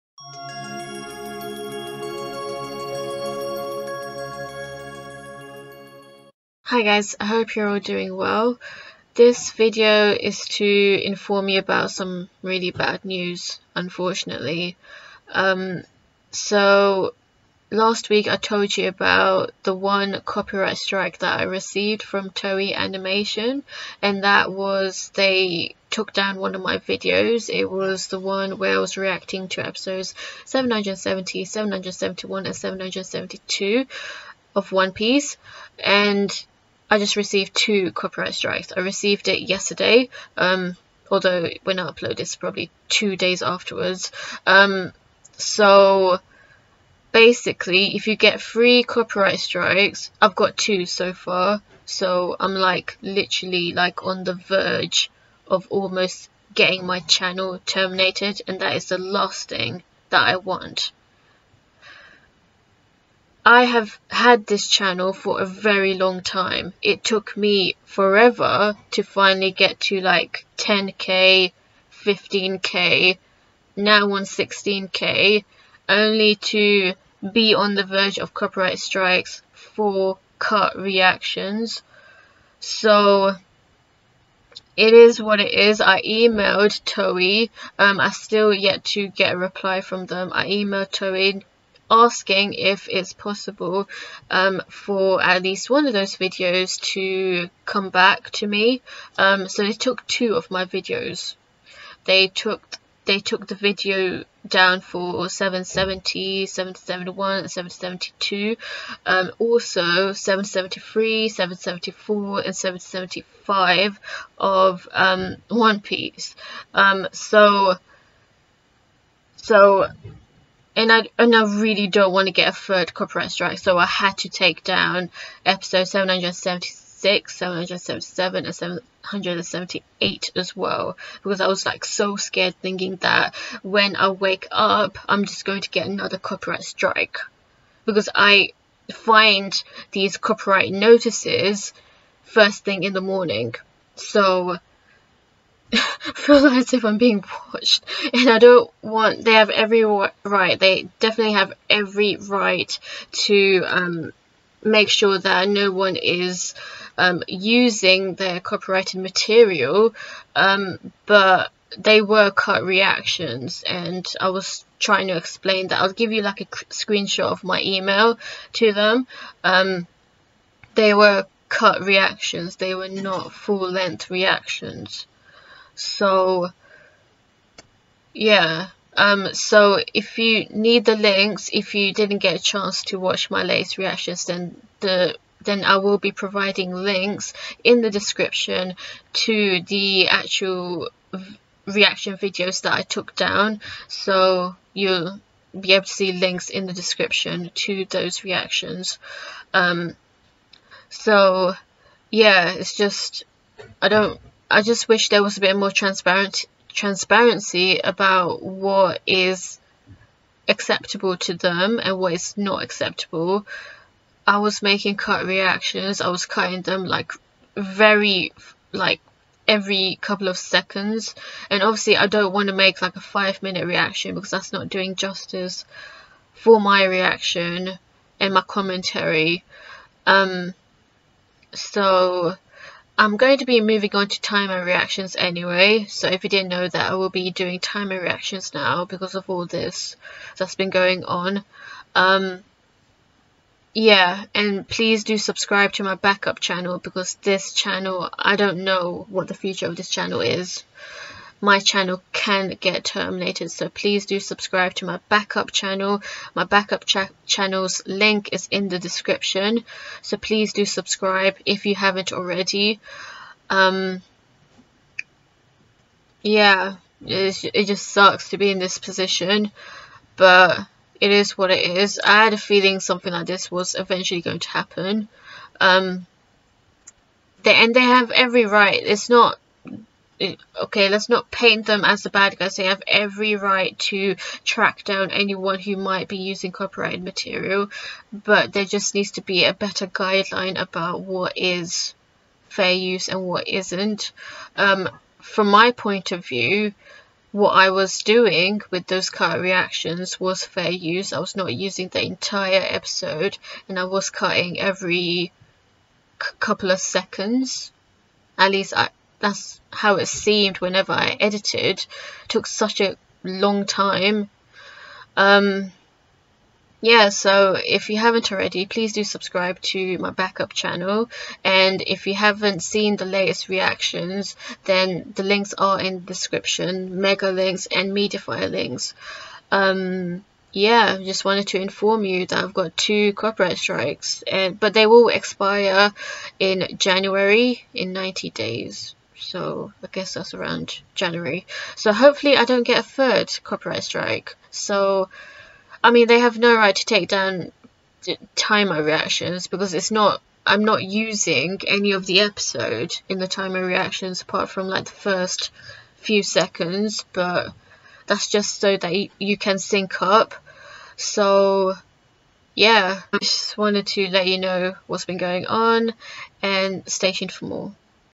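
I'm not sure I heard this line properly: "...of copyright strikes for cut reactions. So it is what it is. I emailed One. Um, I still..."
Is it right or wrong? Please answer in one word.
wrong.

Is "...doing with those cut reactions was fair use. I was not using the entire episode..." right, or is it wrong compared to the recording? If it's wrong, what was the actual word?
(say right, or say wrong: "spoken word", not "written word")
right.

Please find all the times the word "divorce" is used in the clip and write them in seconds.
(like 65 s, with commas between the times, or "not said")
not said.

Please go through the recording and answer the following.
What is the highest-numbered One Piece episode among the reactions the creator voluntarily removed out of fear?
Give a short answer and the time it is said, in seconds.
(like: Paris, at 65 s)
778, at 128 s.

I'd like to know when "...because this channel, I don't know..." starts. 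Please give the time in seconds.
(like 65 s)
246 s.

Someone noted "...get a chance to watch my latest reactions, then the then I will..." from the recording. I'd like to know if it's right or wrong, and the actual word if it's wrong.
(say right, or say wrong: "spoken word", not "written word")
right.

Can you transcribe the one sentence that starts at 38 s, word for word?
I received it yesterday, um, although when I upload it's probably two days afterwards.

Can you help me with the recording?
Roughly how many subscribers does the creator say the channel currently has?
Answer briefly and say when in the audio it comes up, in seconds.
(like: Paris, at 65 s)
16k, at 73 s.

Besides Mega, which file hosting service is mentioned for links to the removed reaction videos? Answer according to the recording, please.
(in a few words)
Mediafire.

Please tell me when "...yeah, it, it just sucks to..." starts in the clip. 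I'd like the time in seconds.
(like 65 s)
266 s.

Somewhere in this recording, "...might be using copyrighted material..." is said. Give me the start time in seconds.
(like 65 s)
285 s.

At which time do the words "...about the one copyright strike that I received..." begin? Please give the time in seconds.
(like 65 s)
18 s.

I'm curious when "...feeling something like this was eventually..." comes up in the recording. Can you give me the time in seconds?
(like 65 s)
272 s.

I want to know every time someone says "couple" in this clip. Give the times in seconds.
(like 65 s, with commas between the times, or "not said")
220 s, 306 s.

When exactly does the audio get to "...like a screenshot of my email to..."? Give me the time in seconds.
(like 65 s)
166 s.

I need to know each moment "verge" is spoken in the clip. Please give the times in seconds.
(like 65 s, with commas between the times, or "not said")
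54 s, 77 s.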